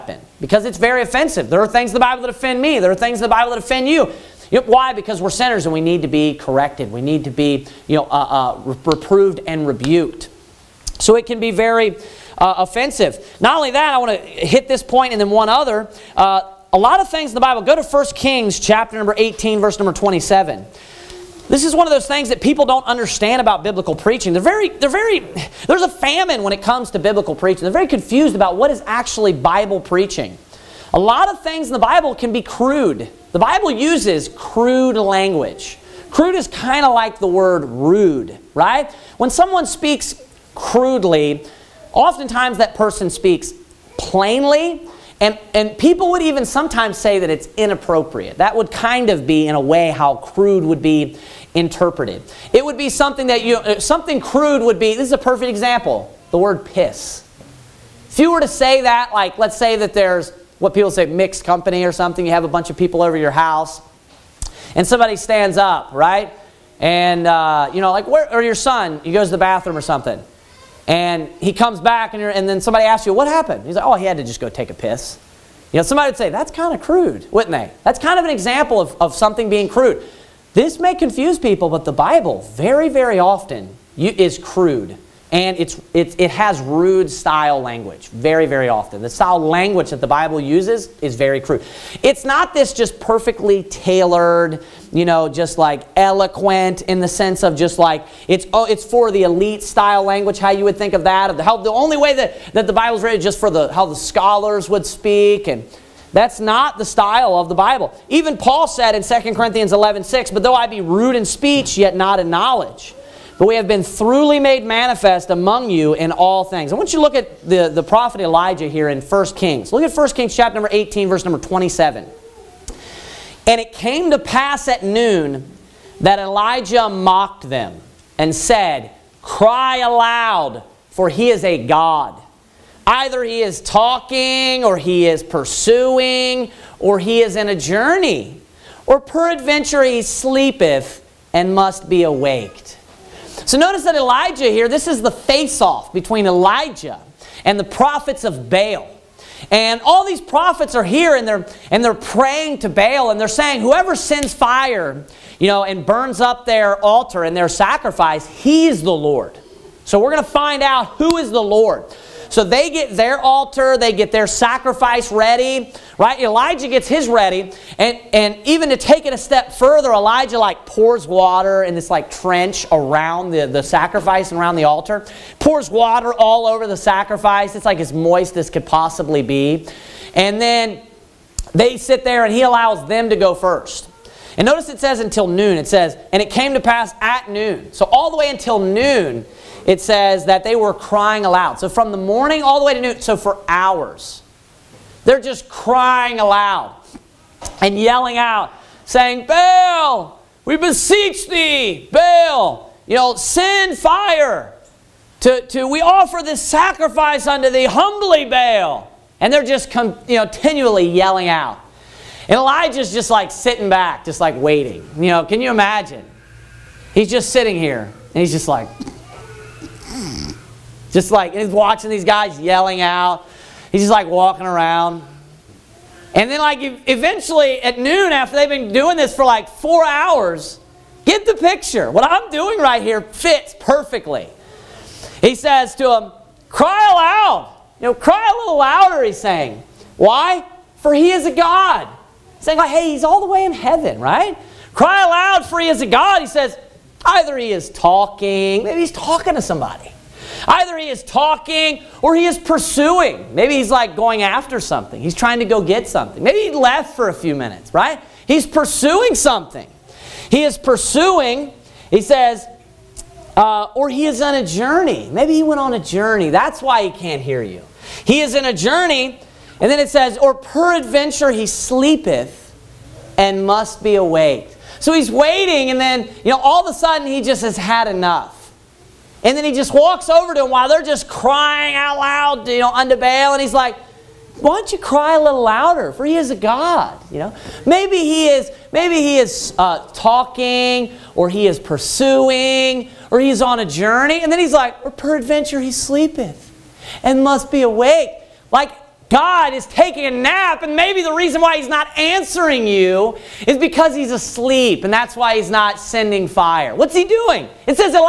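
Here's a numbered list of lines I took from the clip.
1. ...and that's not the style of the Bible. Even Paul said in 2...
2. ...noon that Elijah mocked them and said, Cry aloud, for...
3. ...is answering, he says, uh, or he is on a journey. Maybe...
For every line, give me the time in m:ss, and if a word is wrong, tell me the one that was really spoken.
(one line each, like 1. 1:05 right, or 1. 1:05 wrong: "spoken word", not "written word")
1. 1:45 right
2. 2:04 right
3. 4:20 wrong: "pursuing", not "answering".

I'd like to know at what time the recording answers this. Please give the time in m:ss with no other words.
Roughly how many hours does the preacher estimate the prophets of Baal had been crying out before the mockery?
3:49.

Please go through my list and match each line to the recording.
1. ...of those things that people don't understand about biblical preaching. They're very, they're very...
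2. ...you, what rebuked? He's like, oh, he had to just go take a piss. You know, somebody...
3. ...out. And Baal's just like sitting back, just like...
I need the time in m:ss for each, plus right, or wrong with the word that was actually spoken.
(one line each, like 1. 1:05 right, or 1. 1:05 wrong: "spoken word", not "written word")
1. 0:21 right
2. 1:13 wrong: "happened", not "rebuked"
3. 3:31 wrong: "Elijah", not "Baal".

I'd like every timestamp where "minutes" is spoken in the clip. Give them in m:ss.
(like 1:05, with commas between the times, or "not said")
4:17.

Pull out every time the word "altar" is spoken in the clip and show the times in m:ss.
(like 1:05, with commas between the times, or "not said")
2:36, 2:43, 2:54.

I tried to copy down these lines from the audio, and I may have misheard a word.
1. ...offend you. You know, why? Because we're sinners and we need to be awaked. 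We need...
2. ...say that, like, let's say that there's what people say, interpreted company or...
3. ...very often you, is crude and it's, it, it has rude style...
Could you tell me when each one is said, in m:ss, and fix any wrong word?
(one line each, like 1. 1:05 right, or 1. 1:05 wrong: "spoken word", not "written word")
1. 0:03 wrong: "corrected", not "awaked"
2. 0:58 wrong: "mixed", not "interpreted"
3. 1:22 right.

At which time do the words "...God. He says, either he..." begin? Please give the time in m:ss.
4:05.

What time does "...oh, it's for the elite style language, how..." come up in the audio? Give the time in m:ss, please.
1:38.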